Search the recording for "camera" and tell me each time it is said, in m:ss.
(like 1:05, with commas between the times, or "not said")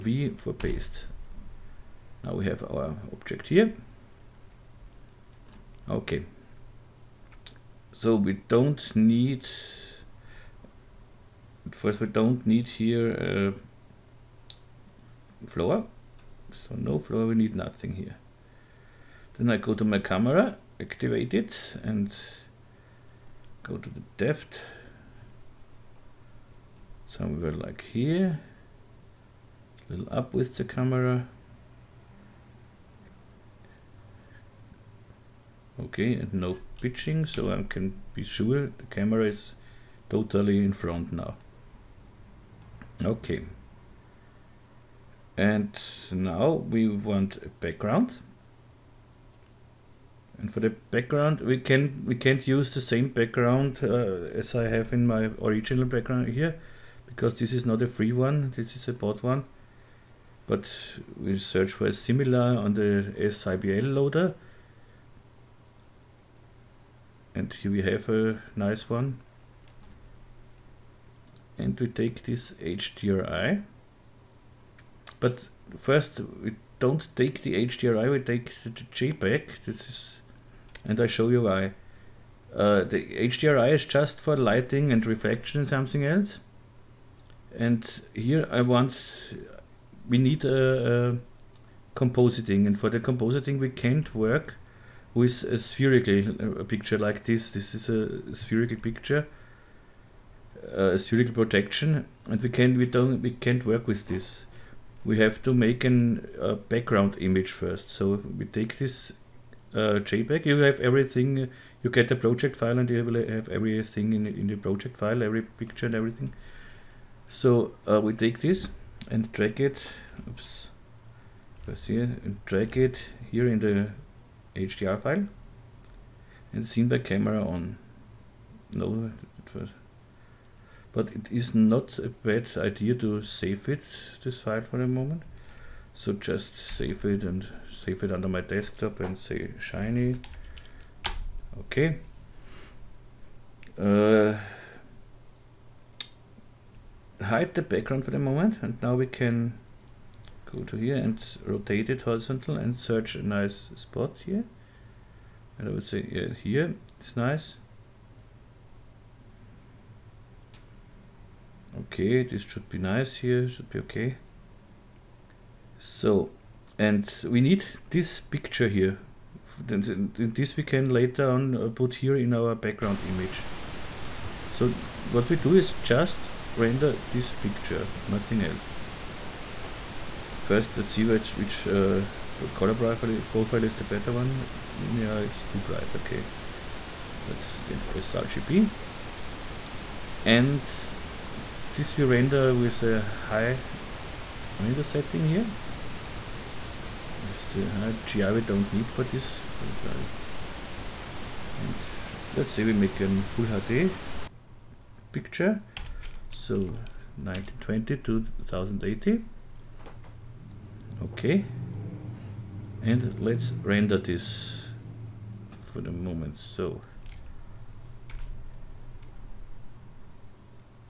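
0:19, 0:30, 0:38, 2:06.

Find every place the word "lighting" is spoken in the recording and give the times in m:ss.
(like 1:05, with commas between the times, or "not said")
1:24.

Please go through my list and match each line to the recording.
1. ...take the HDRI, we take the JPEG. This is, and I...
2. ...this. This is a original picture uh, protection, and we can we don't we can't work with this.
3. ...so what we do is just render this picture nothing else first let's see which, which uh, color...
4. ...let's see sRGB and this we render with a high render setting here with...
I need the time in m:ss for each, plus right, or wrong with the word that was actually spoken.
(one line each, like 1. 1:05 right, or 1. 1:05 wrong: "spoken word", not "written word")
1. 1:17 right
2. 1:37 wrong: "spherical", not "original"
3. 2:54 right
4. 3:07 right.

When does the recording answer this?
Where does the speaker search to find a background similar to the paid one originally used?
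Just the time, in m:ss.
1:03.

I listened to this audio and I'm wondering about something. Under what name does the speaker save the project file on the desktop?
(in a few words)
shiny.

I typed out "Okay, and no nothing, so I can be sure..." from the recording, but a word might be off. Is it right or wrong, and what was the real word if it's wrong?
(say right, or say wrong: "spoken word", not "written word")
wrong: "pitching", not "nothing".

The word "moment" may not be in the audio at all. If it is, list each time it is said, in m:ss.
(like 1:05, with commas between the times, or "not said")
2:14, 2:28, 3:35.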